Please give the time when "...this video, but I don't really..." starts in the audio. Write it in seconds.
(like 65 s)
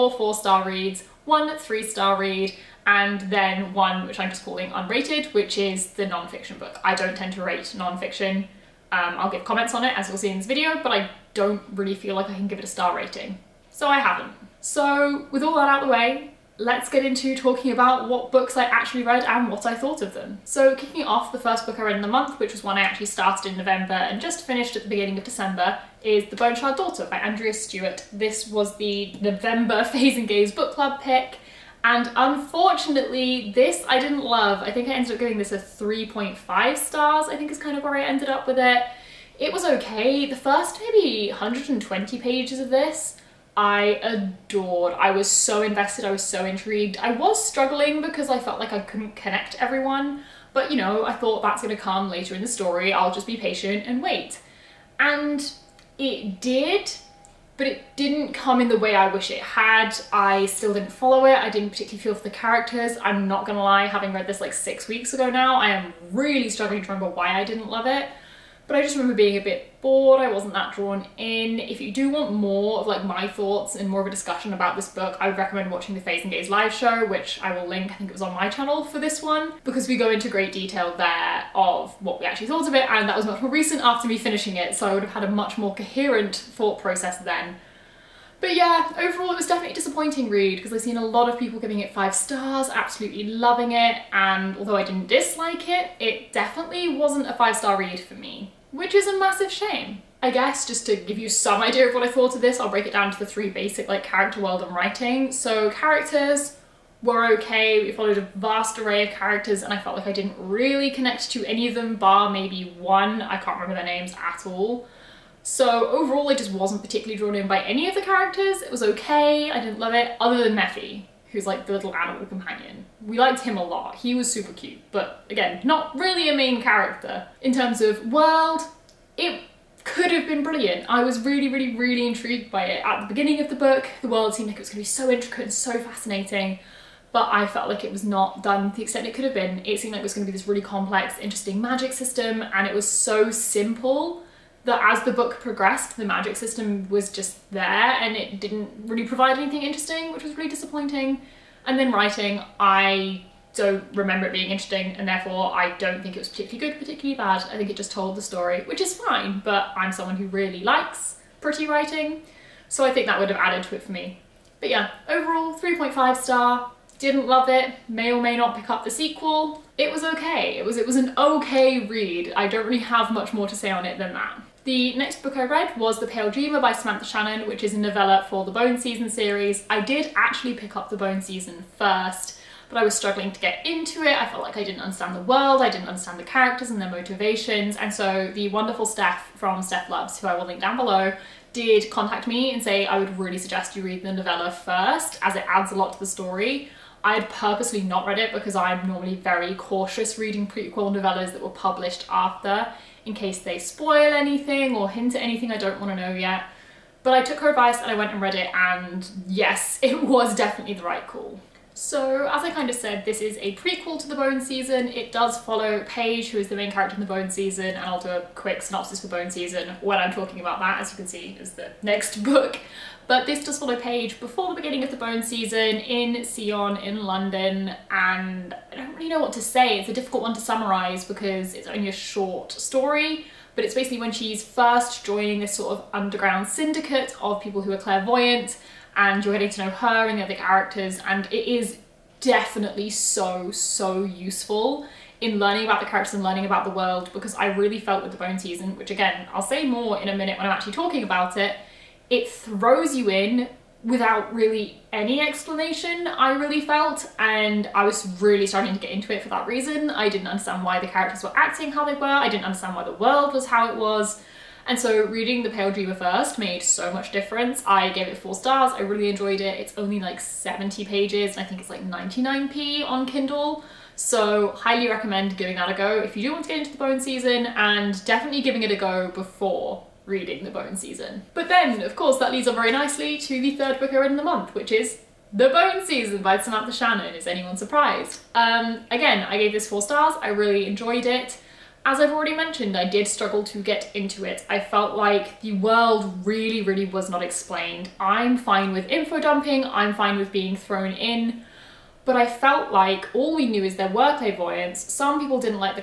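10 s.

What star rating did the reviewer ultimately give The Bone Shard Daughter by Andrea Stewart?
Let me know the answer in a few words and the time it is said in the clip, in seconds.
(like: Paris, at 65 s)
3.5 stars, at 35 s.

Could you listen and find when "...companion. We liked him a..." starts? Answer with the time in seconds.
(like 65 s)
122 s.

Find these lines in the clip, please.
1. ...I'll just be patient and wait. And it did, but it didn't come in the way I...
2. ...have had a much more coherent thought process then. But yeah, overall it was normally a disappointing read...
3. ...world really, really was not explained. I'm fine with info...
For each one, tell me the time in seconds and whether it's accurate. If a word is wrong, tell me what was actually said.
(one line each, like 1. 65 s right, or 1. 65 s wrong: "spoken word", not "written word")
1. 52 s right
2. 85 s wrong: "definitely", not "normally"
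3. 295 s right.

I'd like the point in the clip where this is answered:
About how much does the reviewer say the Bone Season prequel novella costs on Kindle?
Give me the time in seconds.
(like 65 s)
271 s.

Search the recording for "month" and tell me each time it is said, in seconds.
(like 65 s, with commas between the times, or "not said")
22 s, 284 s.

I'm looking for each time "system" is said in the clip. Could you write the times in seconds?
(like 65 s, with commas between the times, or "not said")
141 s, 146 s.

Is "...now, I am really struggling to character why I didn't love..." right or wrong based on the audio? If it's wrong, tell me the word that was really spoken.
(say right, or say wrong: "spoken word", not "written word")
wrong: "remember", not "character".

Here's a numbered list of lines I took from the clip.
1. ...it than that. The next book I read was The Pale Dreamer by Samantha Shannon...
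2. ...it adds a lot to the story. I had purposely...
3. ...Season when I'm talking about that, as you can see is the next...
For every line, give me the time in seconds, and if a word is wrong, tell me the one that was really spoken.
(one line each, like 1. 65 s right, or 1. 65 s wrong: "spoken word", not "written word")
1. 173 s right
2. 195 s right
3. 219 s right.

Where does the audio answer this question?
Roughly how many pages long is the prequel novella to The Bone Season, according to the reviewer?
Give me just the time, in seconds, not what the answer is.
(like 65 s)
270 s.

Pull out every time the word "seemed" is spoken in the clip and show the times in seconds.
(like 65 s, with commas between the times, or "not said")
134 s, 139 s.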